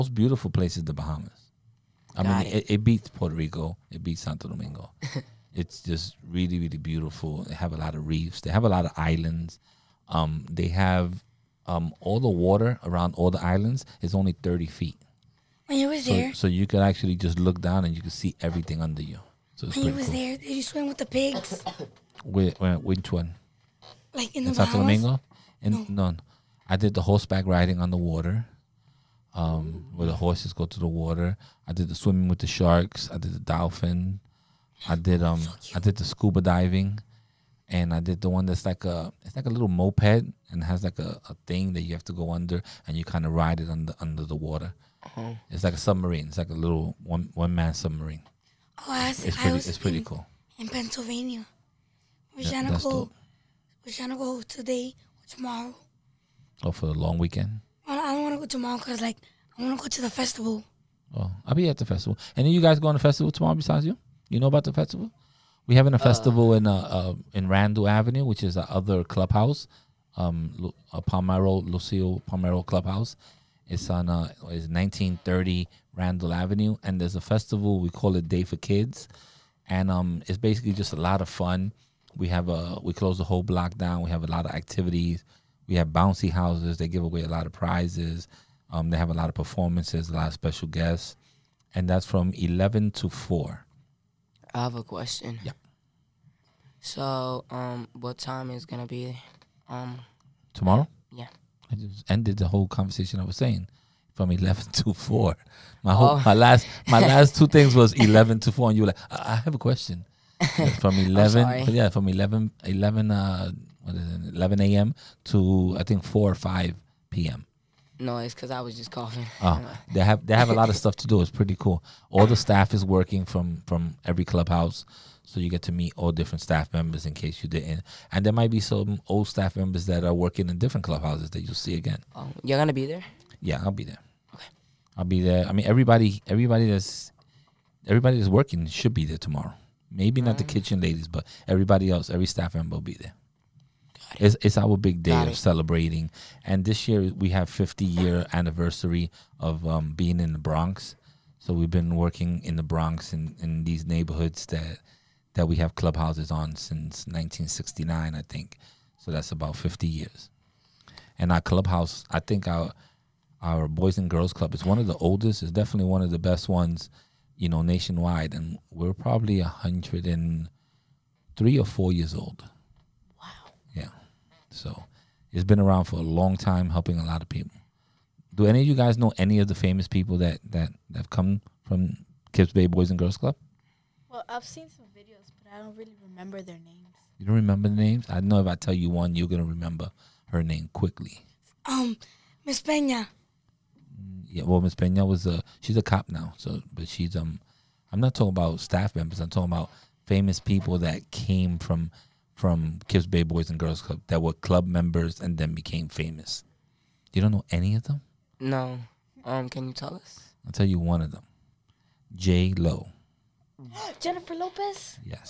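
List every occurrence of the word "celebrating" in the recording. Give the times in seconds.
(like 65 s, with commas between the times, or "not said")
145 s.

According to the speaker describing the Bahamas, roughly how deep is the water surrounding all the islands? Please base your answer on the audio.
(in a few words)
30 feet.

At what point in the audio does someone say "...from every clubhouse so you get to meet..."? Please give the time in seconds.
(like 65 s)
123 s.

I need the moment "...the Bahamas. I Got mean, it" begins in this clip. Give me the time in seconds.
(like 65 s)
0 s.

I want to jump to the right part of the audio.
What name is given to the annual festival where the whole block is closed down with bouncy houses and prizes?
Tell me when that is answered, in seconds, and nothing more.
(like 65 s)
78 s.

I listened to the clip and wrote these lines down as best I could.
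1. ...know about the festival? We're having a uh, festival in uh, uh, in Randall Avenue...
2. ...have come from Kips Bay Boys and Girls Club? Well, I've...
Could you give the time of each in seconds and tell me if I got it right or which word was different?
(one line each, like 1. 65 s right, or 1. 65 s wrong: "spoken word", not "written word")
1. 64 s right
2. 180 s right.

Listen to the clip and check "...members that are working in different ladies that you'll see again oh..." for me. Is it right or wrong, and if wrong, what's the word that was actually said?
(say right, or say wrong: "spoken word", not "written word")
wrong: "clubhouses", not "ladies".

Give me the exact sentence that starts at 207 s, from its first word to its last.
You don't know any of them?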